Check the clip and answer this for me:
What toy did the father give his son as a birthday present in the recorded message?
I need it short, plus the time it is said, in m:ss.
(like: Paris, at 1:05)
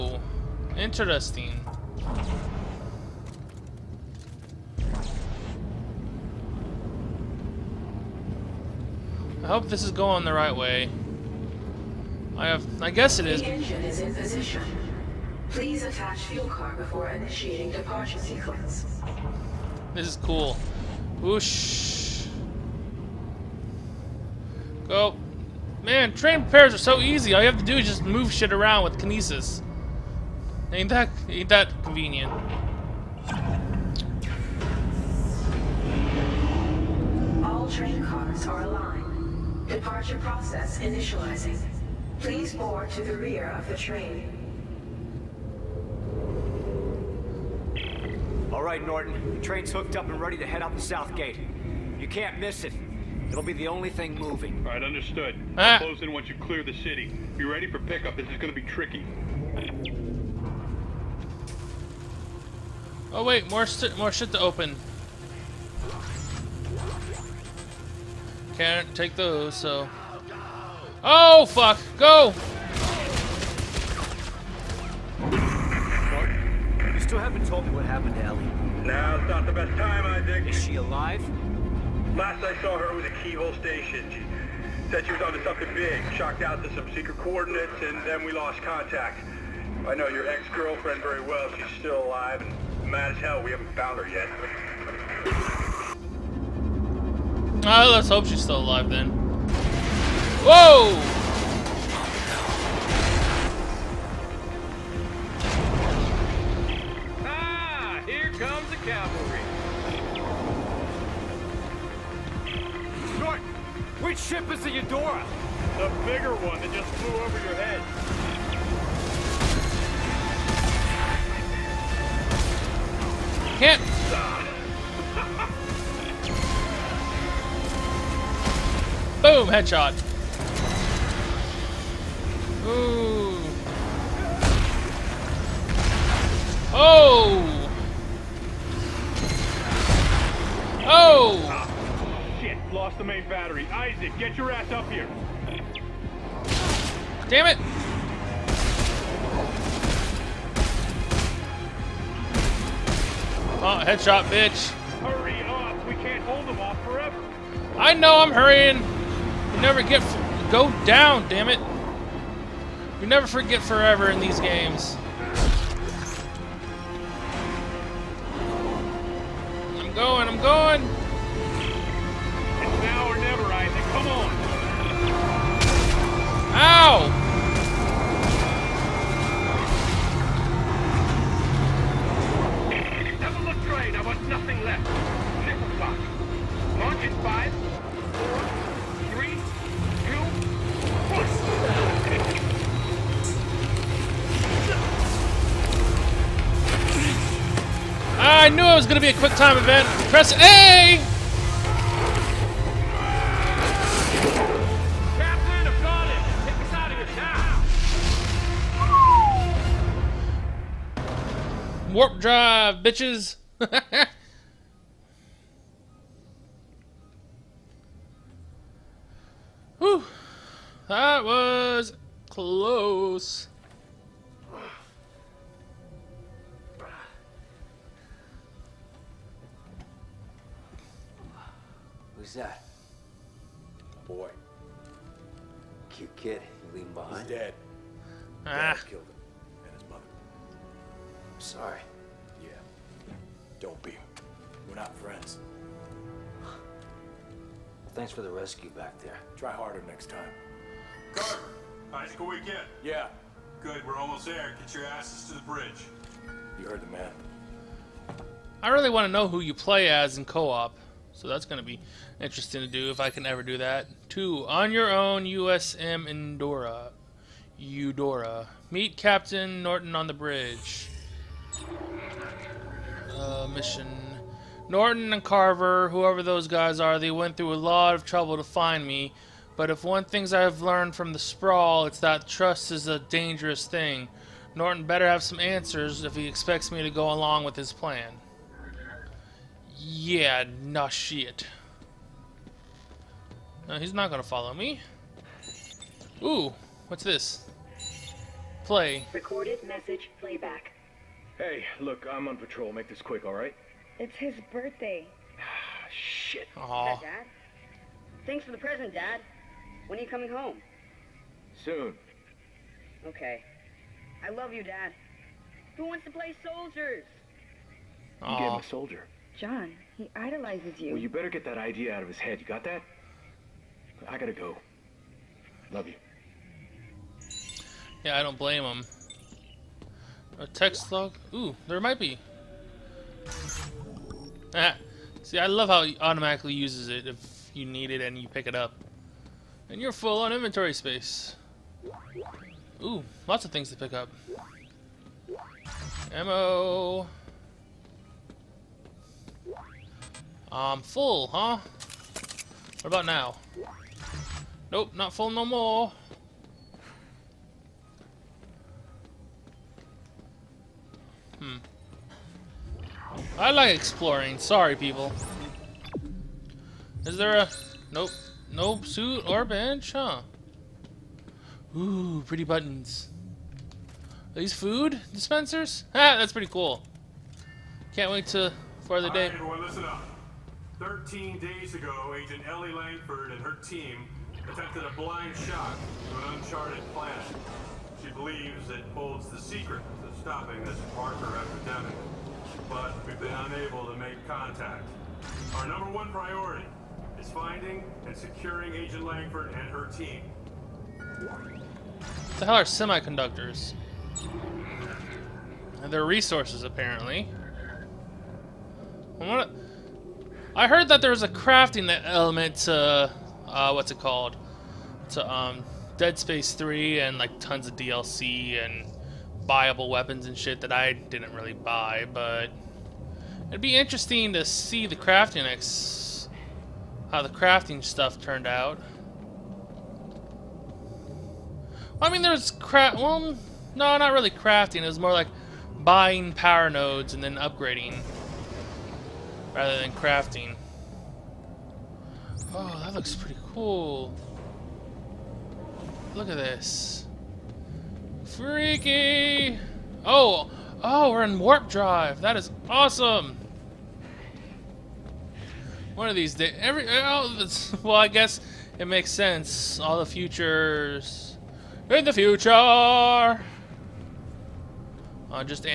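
A soldier, at 5:18.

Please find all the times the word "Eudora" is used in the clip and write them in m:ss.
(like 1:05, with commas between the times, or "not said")
1:54, 4:27.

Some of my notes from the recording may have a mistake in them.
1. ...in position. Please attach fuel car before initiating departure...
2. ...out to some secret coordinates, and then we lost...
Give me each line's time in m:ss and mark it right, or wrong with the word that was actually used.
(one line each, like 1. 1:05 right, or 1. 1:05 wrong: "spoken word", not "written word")
1. 0:13 right
2. 1:26 right.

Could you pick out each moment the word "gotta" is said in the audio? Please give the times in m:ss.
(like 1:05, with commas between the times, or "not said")
5:24.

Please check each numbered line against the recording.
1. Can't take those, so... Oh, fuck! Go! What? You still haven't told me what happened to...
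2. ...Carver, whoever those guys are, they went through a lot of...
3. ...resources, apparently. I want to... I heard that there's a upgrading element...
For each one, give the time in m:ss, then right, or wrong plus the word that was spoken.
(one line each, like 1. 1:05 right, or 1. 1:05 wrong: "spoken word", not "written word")
1. 1:08 right
2. 4:35 right
3. 6:46 wrong: "crafting", not "upgrading".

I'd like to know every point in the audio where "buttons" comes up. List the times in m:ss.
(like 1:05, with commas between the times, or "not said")
6:12.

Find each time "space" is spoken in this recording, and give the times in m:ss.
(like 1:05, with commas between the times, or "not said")
5:40, 6:56.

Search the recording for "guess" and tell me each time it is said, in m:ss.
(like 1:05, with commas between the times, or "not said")
0:12, 7:38.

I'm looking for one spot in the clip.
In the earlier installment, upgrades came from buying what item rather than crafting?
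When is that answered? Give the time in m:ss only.
7:16.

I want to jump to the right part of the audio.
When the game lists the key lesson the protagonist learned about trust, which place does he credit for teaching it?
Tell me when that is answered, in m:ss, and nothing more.
4:41.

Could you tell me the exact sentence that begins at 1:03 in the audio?
Oh wait, more more shit to open.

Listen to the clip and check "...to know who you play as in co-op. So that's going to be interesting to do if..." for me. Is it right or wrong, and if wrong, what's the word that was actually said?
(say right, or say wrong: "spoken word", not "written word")
right.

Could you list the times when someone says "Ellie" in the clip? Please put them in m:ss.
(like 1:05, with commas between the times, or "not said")
1:18, 6:22.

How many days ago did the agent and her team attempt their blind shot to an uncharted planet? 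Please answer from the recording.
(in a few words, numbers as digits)
13.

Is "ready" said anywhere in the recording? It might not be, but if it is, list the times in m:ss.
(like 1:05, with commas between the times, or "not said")
0:50, 0:57.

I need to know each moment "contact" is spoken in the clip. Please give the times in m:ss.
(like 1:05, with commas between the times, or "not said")
1:28, 6:34.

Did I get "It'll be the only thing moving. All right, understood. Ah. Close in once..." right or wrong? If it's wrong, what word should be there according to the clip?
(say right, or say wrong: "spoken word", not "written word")
right.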